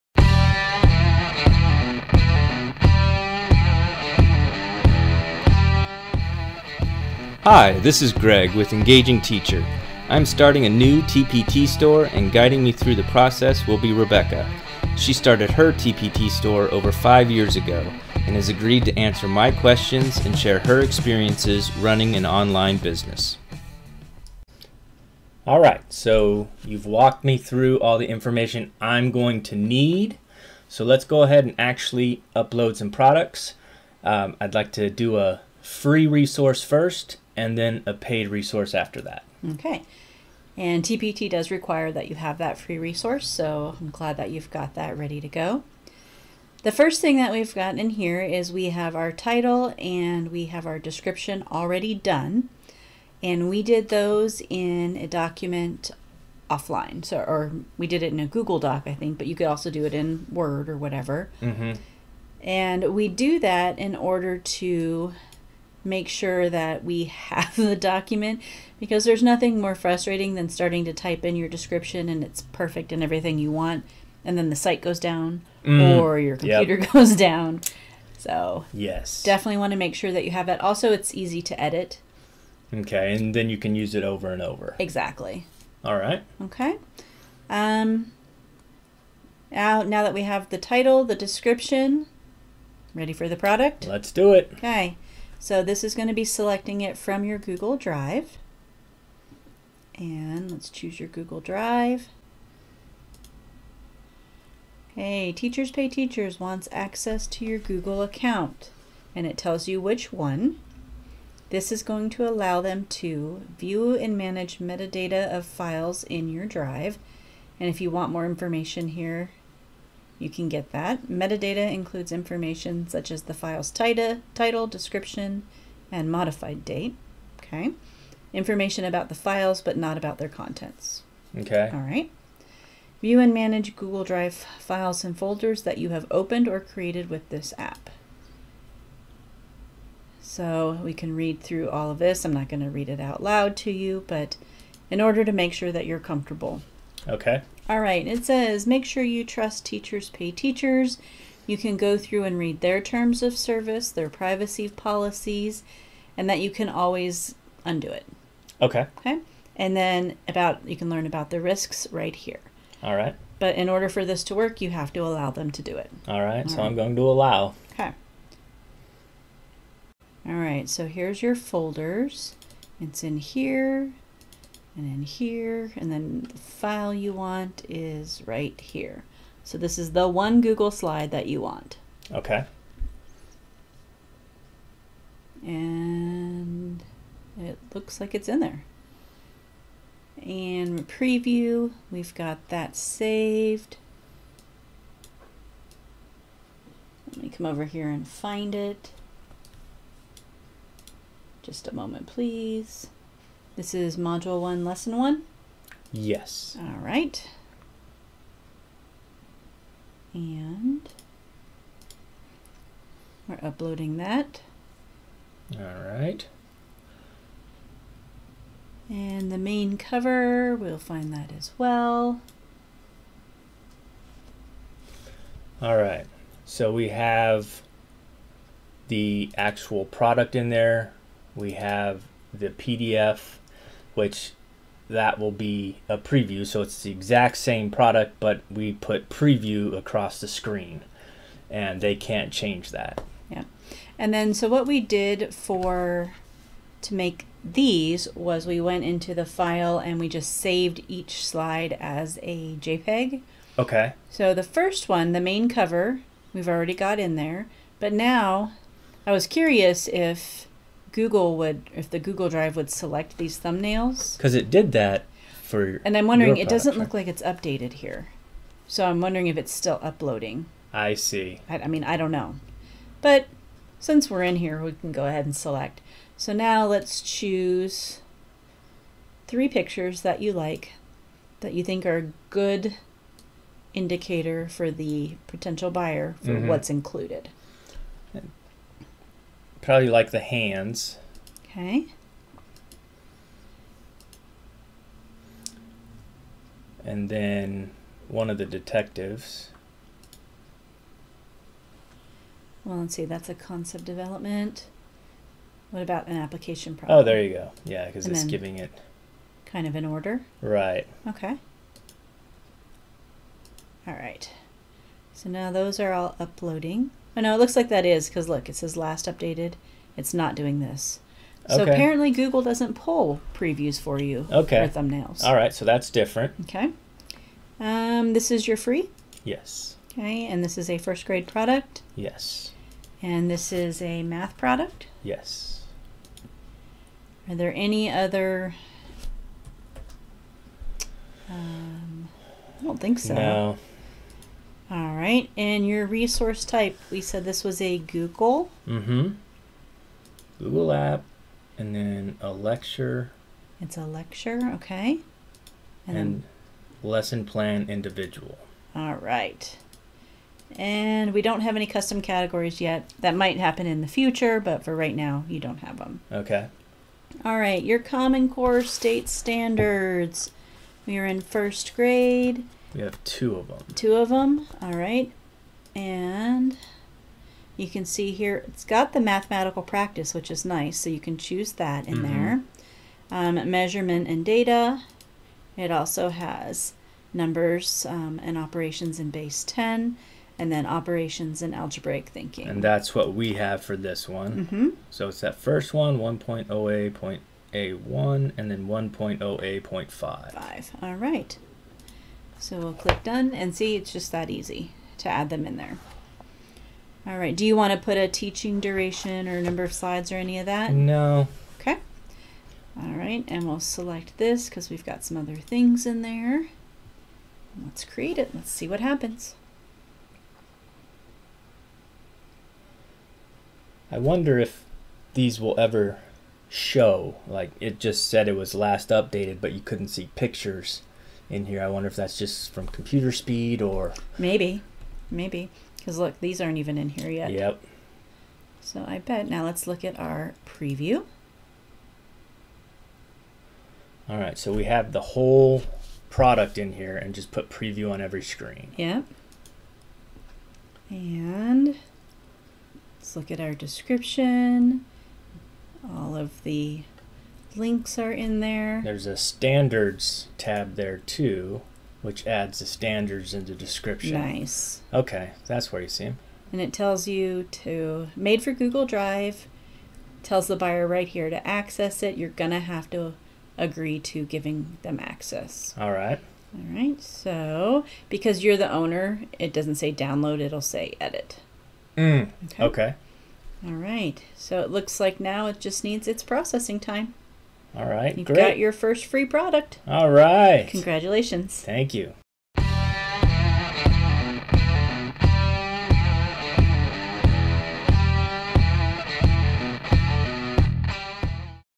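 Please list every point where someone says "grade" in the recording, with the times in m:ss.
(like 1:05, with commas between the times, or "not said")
5:31, 6:11.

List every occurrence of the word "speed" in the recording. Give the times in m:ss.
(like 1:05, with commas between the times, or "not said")
7:13.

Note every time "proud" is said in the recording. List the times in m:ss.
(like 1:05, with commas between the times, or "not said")
not said.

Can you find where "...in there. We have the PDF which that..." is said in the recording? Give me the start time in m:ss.
3:50.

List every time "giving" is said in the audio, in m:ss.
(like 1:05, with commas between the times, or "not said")
5:08, 7:54.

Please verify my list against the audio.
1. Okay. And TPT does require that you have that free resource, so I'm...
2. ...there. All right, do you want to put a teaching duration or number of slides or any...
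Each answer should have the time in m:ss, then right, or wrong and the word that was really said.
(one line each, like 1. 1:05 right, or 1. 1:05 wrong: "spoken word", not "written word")
1. 0:39 right
2. 6:45 right.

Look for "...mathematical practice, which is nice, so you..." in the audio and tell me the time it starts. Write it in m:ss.
6:19.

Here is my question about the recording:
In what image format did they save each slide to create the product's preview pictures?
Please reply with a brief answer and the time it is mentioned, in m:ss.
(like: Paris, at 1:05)
JPEG, at 4:12.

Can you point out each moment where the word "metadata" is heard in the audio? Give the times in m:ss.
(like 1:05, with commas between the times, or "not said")
1:54, 2:01.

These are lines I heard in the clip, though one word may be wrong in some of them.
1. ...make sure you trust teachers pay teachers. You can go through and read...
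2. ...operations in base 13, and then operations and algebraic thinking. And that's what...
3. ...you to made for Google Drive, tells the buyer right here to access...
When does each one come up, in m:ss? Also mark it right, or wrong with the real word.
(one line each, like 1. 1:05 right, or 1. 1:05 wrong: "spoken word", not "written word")
1. 2:28 right
2. 6:28 wrong: "10", not "13"
3. 7:47 right.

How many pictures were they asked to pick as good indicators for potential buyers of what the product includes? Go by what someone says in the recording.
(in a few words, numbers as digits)
3.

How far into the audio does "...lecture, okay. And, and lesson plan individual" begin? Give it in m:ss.
5:53.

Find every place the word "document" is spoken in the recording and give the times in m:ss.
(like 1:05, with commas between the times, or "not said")
0:55, 1:07.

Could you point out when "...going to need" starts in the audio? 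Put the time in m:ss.
0:29.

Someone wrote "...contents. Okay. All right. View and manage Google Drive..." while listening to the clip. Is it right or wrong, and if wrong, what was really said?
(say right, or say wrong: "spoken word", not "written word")
right.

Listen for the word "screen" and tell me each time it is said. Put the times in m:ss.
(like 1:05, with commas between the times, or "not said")
4:00, 7:28.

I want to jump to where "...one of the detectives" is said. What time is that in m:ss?
4:58.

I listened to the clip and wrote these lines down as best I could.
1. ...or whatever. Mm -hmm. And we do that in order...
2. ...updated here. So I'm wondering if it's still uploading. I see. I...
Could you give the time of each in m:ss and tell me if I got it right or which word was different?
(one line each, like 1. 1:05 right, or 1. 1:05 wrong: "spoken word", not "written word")
1. 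1:00 right
2. 4:27 right.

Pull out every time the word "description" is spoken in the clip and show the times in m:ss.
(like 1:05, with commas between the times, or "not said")
0:50, 1:11, 1:31, 2:04, 7:33, 7:43.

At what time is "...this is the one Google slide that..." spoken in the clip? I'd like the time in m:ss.
2:59.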